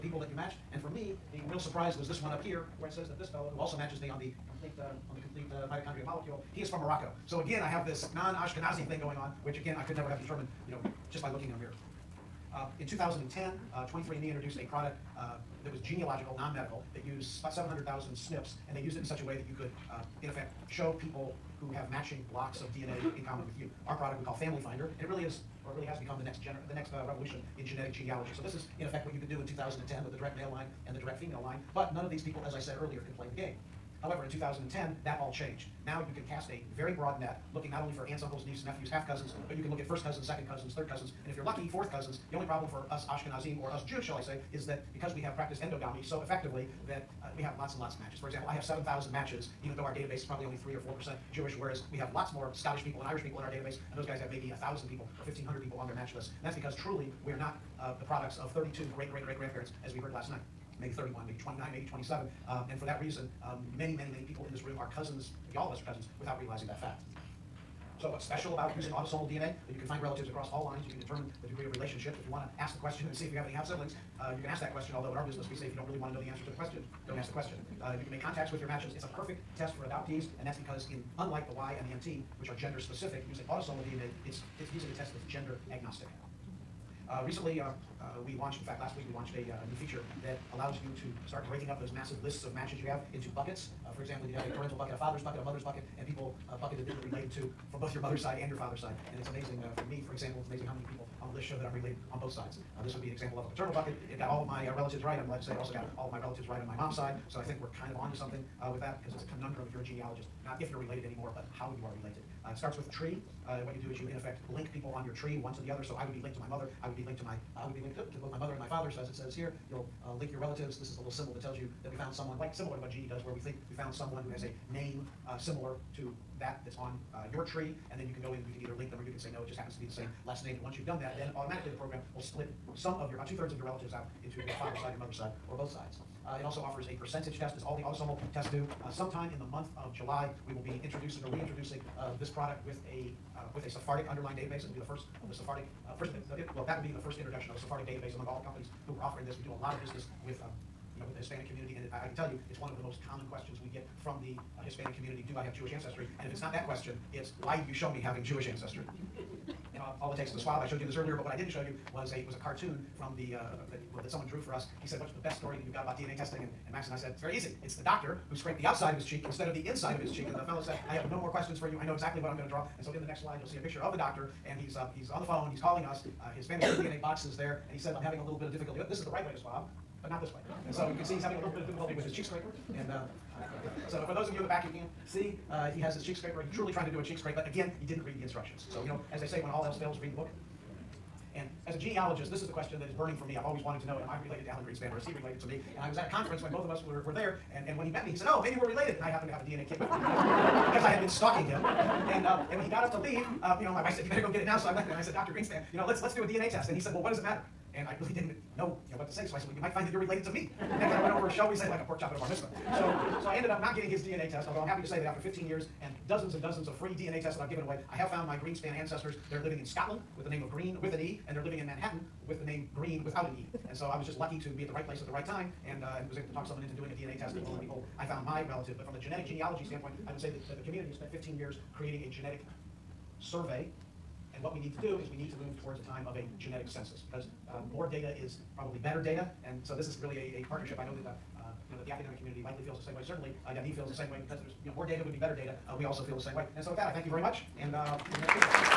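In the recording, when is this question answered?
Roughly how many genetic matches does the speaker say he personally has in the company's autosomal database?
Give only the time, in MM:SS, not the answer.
00:48.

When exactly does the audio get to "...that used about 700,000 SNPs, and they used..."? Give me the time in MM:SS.
00:16.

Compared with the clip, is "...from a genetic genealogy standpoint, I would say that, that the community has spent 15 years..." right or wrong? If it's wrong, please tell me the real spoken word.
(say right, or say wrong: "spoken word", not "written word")
right.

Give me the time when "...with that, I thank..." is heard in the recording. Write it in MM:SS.
04:06.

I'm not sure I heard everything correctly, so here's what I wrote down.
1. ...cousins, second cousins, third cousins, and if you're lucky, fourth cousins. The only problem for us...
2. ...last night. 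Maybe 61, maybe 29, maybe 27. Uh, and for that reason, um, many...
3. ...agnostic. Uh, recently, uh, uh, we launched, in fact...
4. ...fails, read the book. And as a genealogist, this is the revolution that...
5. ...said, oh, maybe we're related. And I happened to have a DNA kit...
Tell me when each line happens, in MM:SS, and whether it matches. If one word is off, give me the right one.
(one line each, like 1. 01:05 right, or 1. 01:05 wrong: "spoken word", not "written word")
1. 00:40 right
2. 01:00 wrong: "31", not "61"
3. 01:25 right
4. 03:09 wrong: "question", not "revolution"
5. 03:18 right.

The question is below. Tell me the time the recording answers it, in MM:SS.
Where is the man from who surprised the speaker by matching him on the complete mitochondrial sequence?
00:06.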